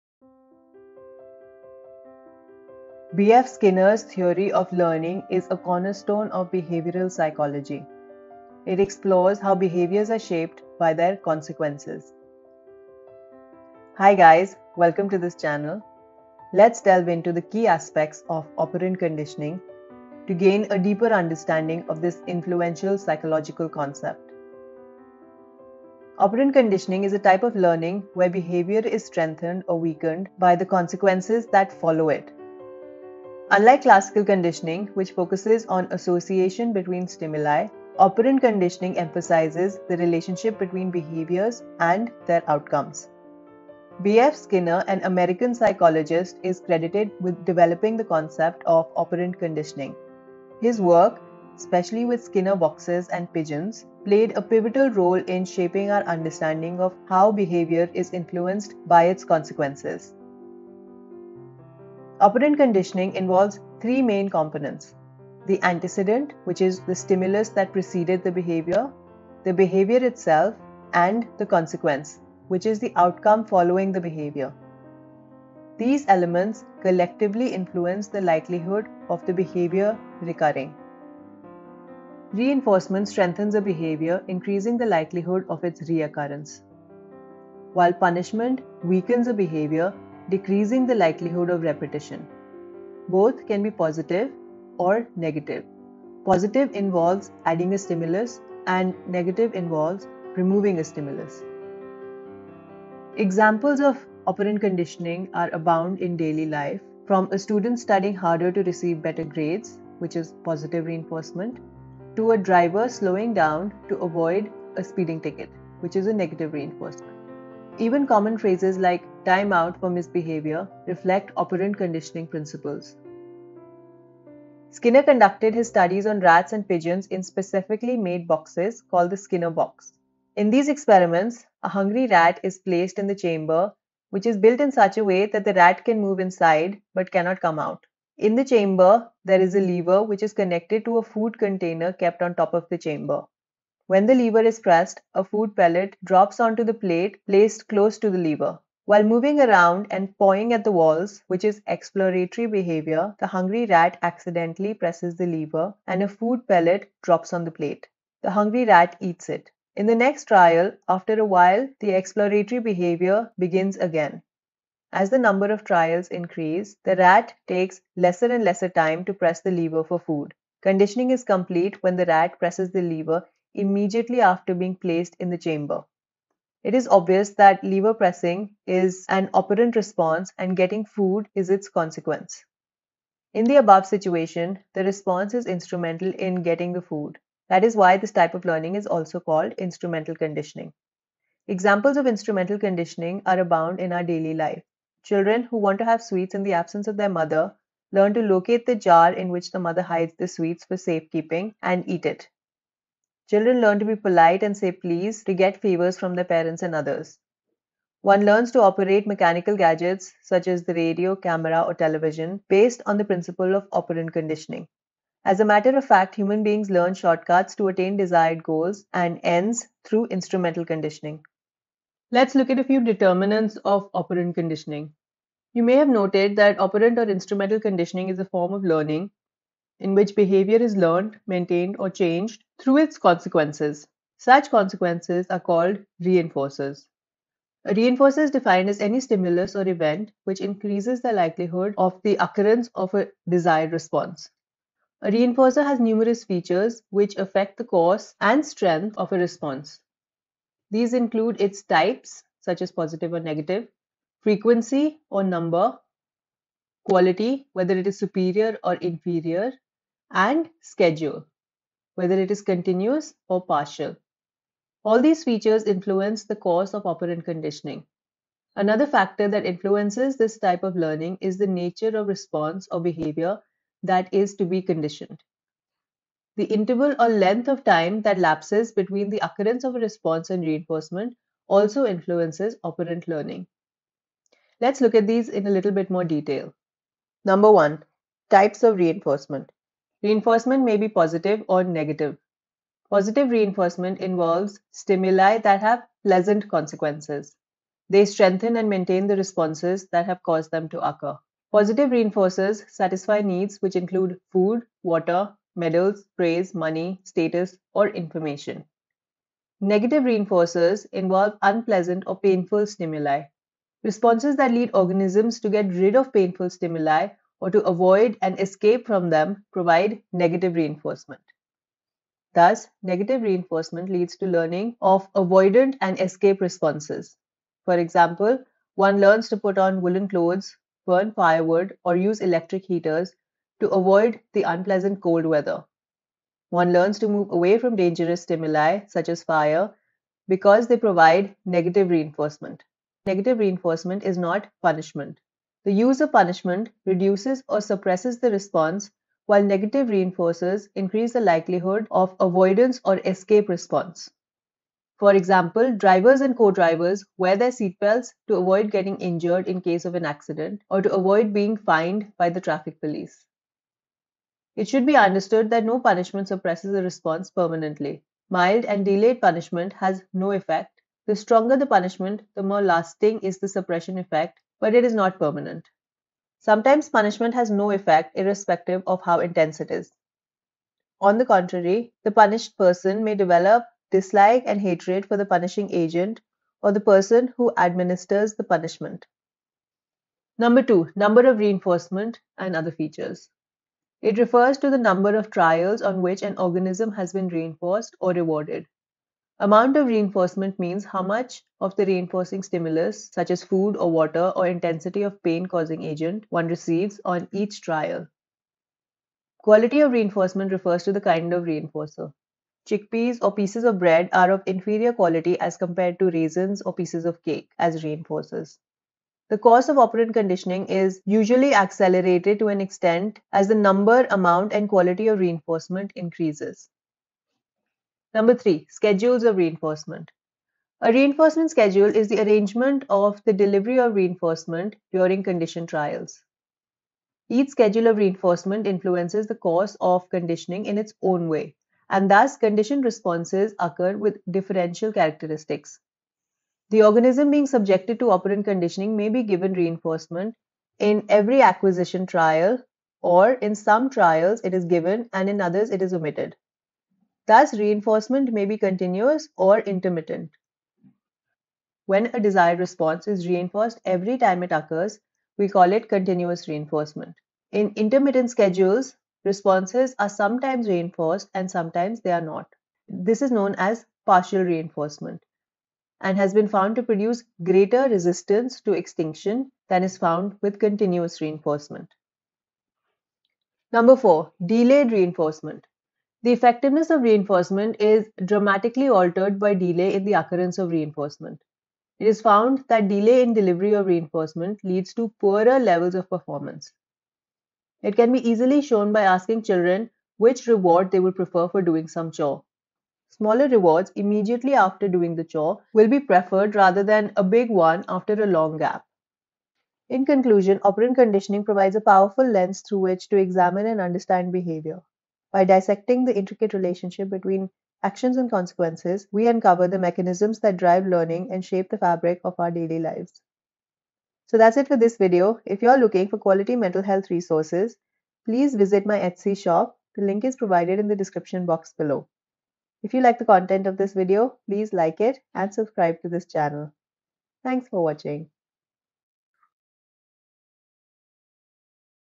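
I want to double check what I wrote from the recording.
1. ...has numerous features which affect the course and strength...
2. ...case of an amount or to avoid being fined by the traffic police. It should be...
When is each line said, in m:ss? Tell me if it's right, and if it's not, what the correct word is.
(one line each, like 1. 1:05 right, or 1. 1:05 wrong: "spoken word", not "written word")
1. 4:05 right
2. 5:59 wrong: "accident", not "amount".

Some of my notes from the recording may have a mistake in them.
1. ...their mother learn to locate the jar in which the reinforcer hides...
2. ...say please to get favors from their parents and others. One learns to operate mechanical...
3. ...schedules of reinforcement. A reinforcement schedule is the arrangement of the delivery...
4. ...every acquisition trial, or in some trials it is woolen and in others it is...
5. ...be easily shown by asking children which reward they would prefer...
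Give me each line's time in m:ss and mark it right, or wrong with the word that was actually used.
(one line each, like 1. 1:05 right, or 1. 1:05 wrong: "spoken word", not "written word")
1. 3:16 wrong: "mother", not "reinforcer"
2. 3:24 right
3. 7:08 right
4. 7:31 wrong: "given", not "woolen"
5. 8:18 right.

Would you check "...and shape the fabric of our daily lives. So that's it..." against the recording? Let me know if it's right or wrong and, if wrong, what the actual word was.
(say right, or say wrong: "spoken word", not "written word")
right.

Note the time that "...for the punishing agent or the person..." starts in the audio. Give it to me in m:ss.
6:25.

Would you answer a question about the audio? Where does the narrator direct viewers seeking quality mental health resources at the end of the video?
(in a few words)
Etsy shop.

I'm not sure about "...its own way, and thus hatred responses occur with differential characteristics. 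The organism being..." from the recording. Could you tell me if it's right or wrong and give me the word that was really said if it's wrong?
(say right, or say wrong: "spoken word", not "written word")
wrong: "conditioned", not "hatred".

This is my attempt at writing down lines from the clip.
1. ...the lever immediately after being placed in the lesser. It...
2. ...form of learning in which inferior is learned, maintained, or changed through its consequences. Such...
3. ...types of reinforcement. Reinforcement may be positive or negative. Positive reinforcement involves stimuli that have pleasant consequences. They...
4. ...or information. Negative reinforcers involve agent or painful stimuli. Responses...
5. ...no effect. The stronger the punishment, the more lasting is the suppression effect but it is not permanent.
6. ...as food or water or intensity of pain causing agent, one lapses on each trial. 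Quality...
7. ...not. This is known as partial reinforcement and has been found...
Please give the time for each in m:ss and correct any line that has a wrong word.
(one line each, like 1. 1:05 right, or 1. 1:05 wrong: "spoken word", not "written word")
1. 2:52 wrong: "chamber", not "lesser"
2. 3:48 wrong: "behavior", not "inferior"
3. 4:48 right
4. 5:07 wrong: "unpleasant", not "agent"
5. 6:10 right
6. 6:43 wrong: "receives", not "lapses"
7. 7:52 right.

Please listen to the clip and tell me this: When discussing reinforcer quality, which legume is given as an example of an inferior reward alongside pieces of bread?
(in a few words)
chickpeas.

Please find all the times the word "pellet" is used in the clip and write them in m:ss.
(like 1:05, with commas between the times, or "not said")
2:25, 2:36.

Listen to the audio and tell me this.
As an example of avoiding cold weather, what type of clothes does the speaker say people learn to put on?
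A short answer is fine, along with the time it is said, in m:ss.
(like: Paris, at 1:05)
woolen clothes, at 5:29.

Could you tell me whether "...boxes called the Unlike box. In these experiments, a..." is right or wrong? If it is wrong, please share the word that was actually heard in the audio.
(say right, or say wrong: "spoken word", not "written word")
wrong: "Skinner", not "Unlike".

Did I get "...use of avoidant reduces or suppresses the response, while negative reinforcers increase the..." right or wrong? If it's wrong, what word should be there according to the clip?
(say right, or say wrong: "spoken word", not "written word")
wrong: "punishment", not "avoidant".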